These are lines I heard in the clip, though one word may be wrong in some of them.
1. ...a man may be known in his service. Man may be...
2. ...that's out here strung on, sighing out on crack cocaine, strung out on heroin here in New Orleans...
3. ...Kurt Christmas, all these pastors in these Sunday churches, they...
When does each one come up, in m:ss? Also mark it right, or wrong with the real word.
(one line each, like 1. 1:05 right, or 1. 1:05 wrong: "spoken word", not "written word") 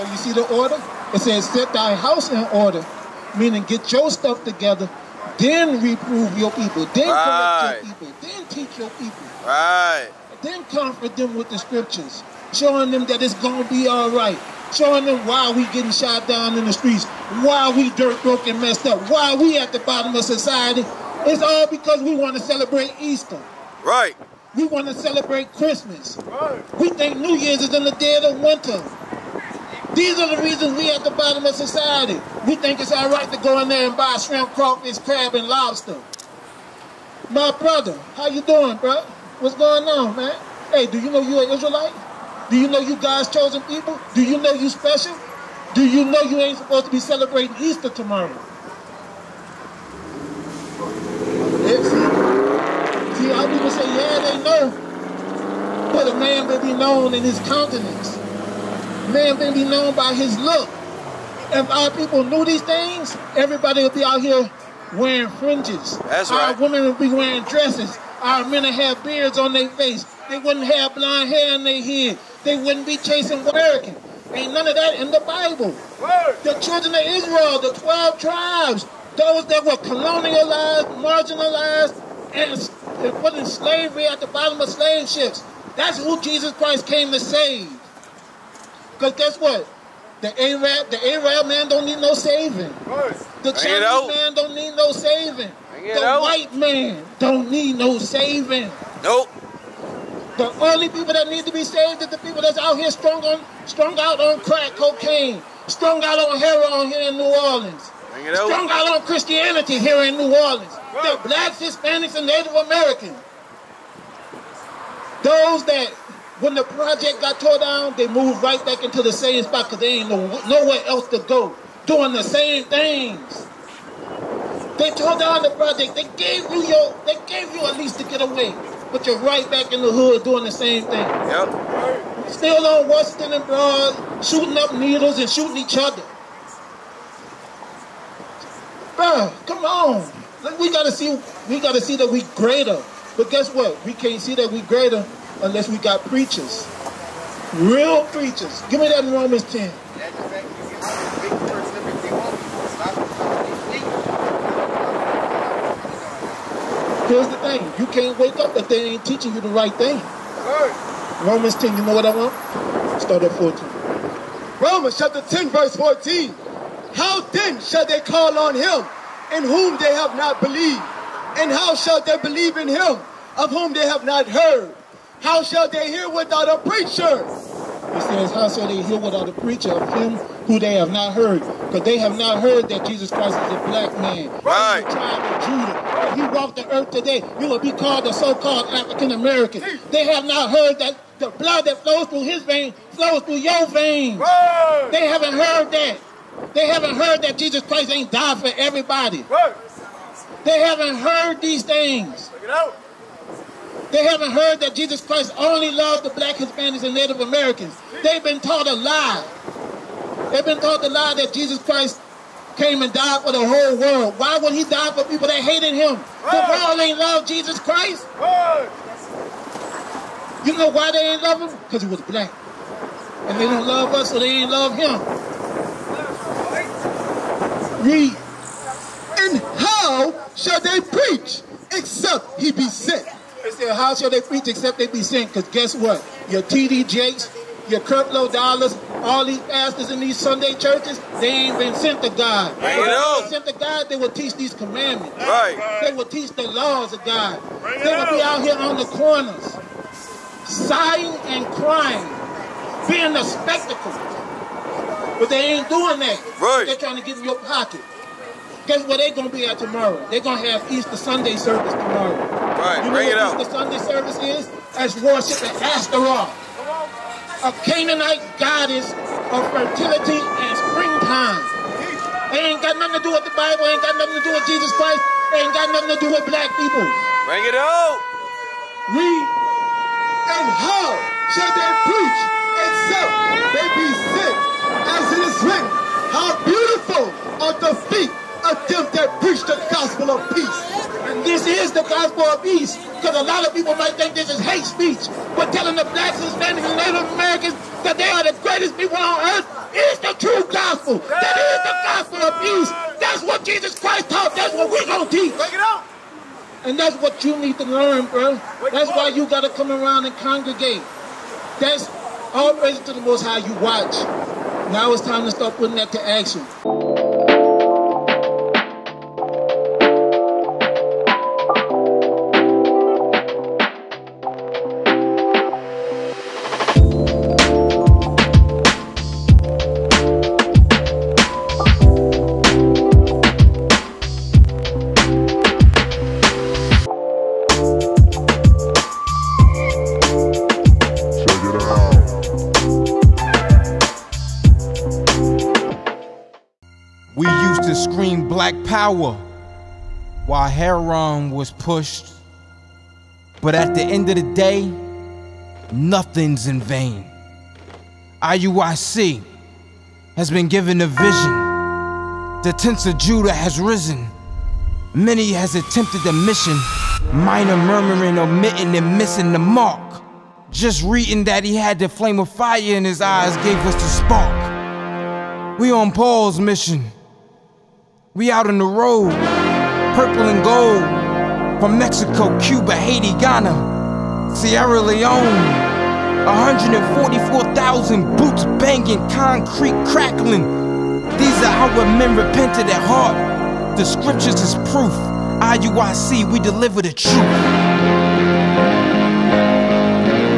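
1. 0:56 wrong: "countenance", not "service"
2. 1:42 wrong: "strung", not "sighing"
3. 3:57 wrong: "Dollars", not "Christmas".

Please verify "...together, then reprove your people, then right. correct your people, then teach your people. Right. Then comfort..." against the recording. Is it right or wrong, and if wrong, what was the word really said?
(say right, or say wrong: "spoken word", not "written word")
right.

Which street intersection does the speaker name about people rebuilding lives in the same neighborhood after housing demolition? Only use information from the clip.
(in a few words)
Washington and Broad.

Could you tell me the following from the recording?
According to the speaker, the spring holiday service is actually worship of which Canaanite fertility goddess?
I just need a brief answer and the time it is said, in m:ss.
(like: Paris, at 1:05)
Ashtaroth, at 4:25.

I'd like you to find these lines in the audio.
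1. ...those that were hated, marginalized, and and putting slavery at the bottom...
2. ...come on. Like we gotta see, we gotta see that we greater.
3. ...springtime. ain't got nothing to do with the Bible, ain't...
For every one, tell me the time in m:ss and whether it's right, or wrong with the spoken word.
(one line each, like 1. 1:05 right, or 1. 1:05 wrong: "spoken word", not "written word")
1. 1:19 wrong: "colonialized", not "hated"
2. 2:19 right
3. 4:30 right.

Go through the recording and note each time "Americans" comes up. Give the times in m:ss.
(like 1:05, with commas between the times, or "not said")
1:13, 1:52, 3:09, 3:27, 4:57.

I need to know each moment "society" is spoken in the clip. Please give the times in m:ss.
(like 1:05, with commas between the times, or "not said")
0:20, 0:31.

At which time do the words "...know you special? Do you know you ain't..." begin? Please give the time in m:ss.
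0:44.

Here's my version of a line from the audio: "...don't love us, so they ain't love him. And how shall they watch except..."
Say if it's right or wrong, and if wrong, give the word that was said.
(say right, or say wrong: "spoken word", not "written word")
wrong: "preach", not "watch".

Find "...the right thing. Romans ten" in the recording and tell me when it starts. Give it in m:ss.
2:39.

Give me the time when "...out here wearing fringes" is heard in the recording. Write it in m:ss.
1:04.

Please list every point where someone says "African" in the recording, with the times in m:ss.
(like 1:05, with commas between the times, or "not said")
3:08.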